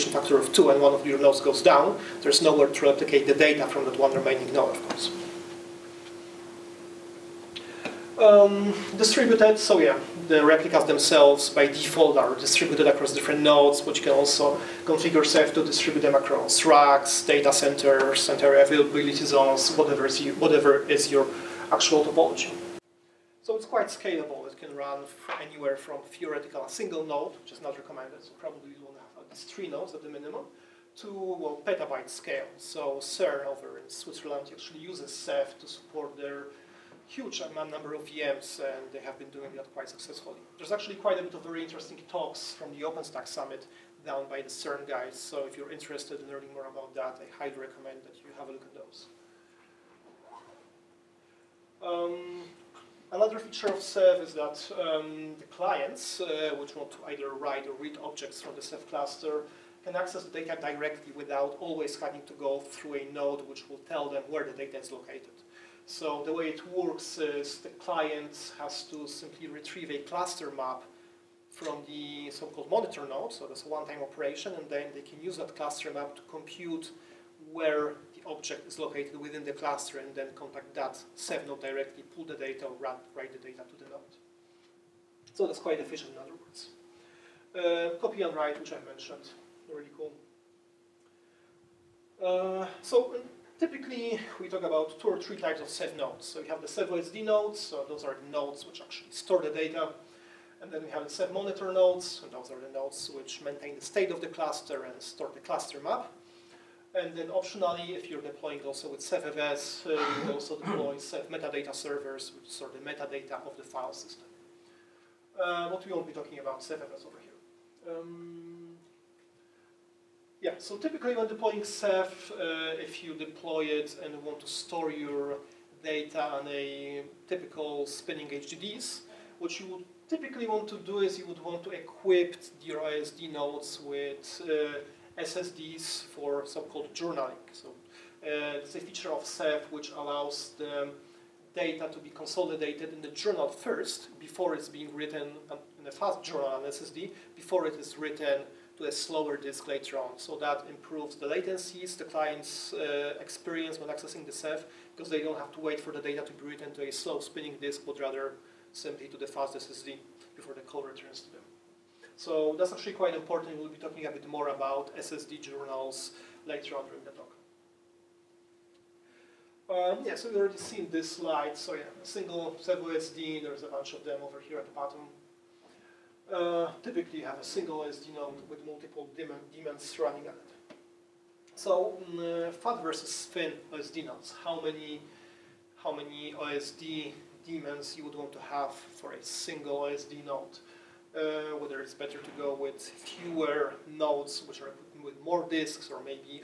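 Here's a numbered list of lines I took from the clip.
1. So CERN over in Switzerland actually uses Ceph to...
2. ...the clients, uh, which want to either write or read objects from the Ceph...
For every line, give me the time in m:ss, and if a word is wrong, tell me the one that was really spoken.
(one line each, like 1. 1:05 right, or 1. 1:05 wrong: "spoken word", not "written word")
1. 0:32 right
2. 0:55 right.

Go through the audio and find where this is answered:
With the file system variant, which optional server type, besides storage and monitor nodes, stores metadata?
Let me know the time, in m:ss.
1:50.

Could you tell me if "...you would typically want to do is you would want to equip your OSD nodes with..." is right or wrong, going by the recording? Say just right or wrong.
right.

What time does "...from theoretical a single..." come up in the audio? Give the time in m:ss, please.
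0:25.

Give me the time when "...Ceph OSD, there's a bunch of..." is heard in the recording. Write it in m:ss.
2:52.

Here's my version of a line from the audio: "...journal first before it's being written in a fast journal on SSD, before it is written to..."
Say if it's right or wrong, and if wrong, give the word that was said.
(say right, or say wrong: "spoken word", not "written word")
right.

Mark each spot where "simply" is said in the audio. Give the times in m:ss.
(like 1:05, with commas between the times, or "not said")
1:09, 2:38.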